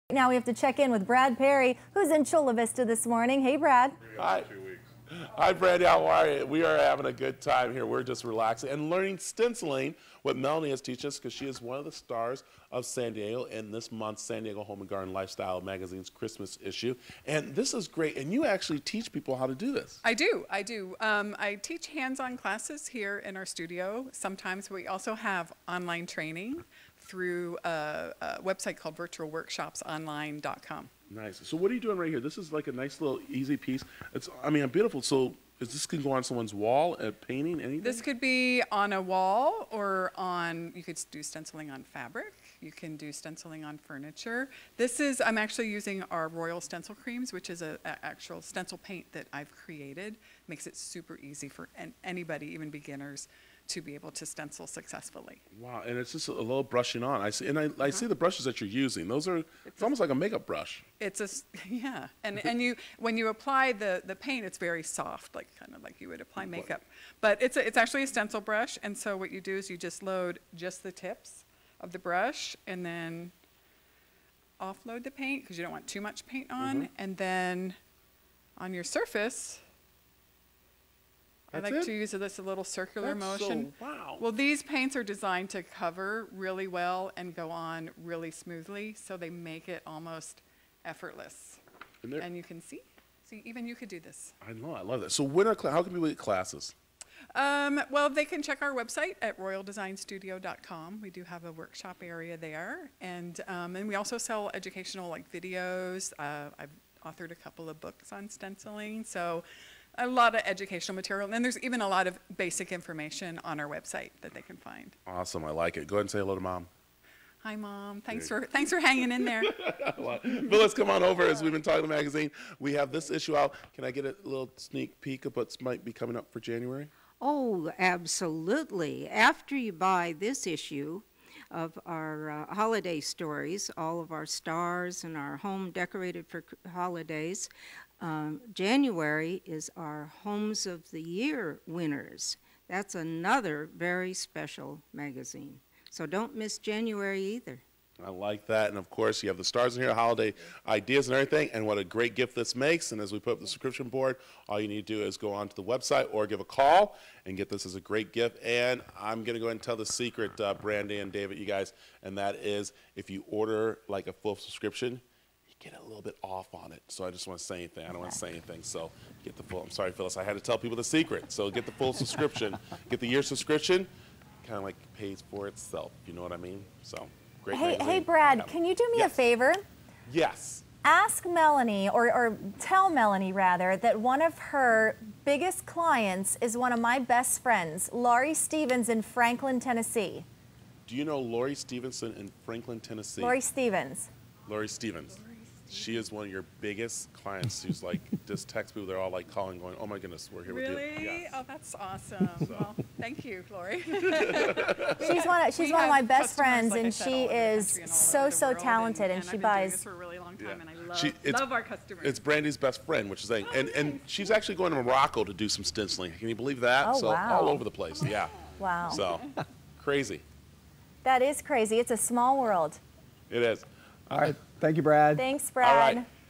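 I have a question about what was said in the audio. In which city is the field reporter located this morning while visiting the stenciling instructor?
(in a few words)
Chula Vista.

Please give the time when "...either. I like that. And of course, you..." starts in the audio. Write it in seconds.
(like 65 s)
147 s.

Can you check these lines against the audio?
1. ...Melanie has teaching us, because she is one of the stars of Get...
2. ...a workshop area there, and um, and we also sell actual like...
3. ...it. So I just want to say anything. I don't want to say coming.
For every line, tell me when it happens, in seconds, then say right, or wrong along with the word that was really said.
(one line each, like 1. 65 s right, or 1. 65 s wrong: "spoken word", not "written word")
1. 10 s wrong: "San", not "Get"
2. 101 s wrong: "educational", not "actual"
3. 166 s wrong: "anything", not "coming".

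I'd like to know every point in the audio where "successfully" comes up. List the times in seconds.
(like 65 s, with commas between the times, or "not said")
54 s.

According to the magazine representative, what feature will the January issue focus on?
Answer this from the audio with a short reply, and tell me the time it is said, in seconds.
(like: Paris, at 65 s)
Homes of the Year winners, at 140 s.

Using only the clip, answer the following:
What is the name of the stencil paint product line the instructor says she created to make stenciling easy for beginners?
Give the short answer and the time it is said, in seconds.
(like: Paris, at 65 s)
Royal Stencil Creams, at 46 s.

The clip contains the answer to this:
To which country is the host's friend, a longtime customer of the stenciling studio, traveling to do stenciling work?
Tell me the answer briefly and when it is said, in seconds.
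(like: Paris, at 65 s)
Morocco, at 214 s.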